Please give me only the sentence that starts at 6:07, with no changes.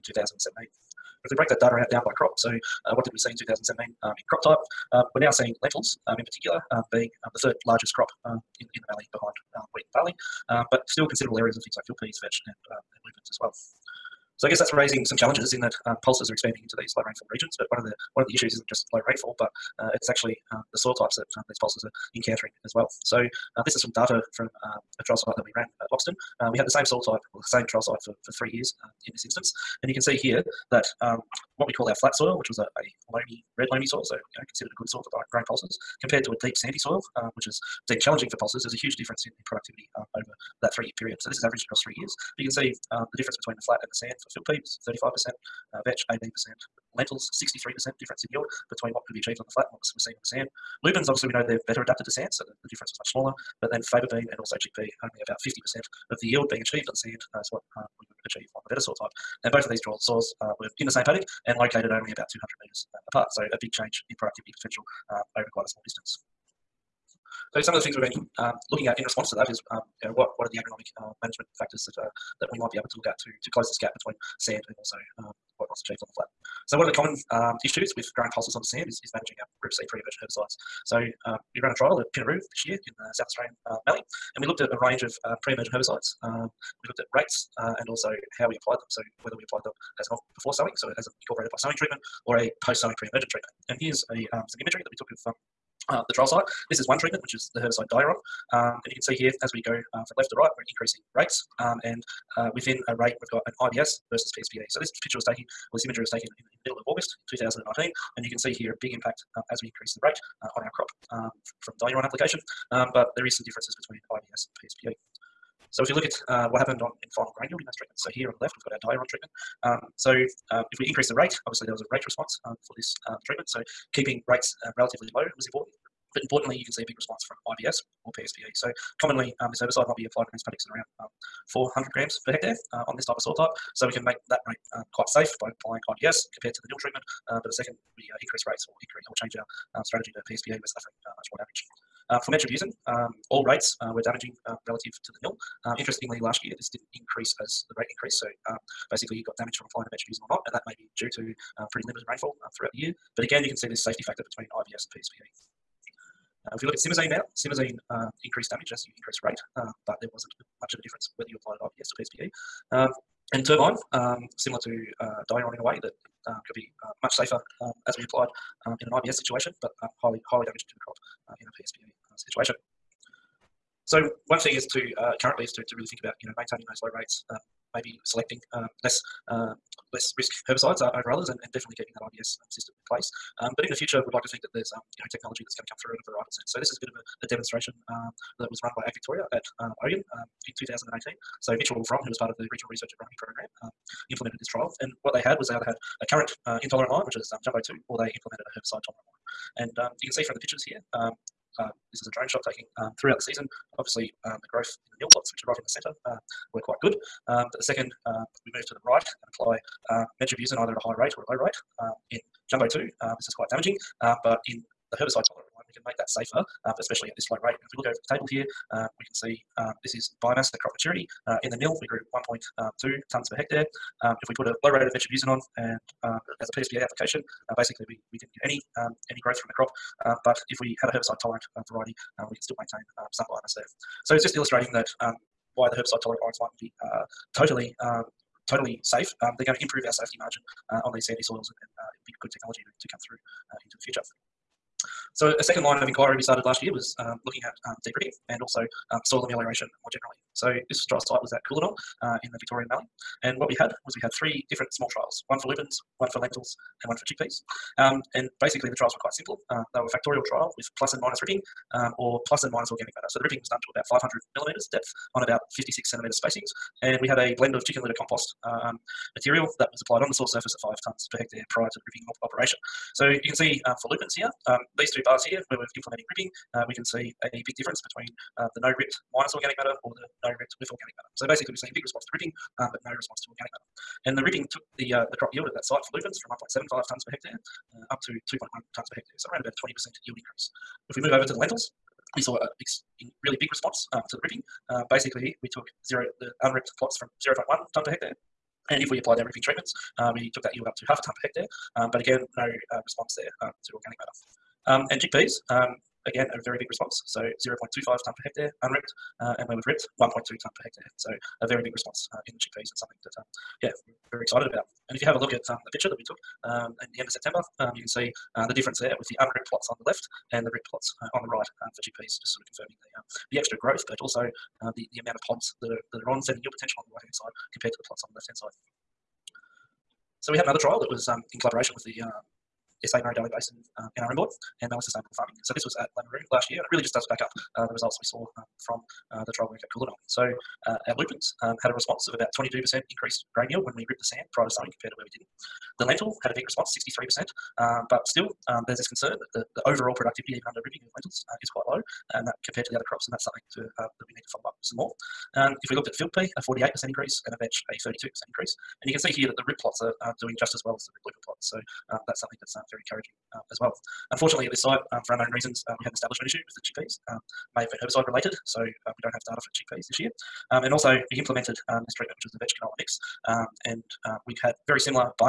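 Um, may have been herbicide related, so uh, we don't have data for chickpeas this year.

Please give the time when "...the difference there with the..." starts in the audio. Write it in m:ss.
5:18.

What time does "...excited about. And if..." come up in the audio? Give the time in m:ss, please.
5:14.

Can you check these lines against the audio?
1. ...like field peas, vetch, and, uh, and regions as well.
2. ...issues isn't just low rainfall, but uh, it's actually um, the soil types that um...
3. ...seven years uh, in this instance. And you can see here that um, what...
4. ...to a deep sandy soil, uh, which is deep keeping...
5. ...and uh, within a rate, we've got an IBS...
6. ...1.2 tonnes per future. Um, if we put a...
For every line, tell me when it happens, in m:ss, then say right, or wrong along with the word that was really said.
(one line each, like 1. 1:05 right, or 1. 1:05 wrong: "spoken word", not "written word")
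1. 0:11 wrong: "lupins", not "regions"
2. 0:18 right
3. 0:28 wrong: "three", not "seven"
4. 0:36 wrong: "challenging", not "keeping"
5. 1:41 right
6. 3:42 wrong: "hectare", not "future".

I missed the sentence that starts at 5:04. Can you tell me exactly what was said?
Um, and chickpeas, um, again, a very big response.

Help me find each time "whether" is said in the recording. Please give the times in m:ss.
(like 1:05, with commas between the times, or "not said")
1:29, 2:41.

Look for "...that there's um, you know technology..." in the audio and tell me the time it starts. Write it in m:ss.
3:04.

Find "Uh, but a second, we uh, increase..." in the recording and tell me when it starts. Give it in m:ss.
2:17.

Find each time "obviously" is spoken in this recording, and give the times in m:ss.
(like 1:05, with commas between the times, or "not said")
0:51, 2:01, 3:23.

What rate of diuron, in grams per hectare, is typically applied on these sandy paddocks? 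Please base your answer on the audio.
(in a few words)
400.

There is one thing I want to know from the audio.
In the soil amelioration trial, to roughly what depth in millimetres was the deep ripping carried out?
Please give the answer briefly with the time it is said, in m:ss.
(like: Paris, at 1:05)
500 millimetres, at 4:23.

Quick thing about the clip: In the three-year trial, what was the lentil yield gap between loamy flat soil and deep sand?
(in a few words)
63%.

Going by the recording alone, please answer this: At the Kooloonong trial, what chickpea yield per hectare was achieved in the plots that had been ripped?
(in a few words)
1.2 tonnes per hectare.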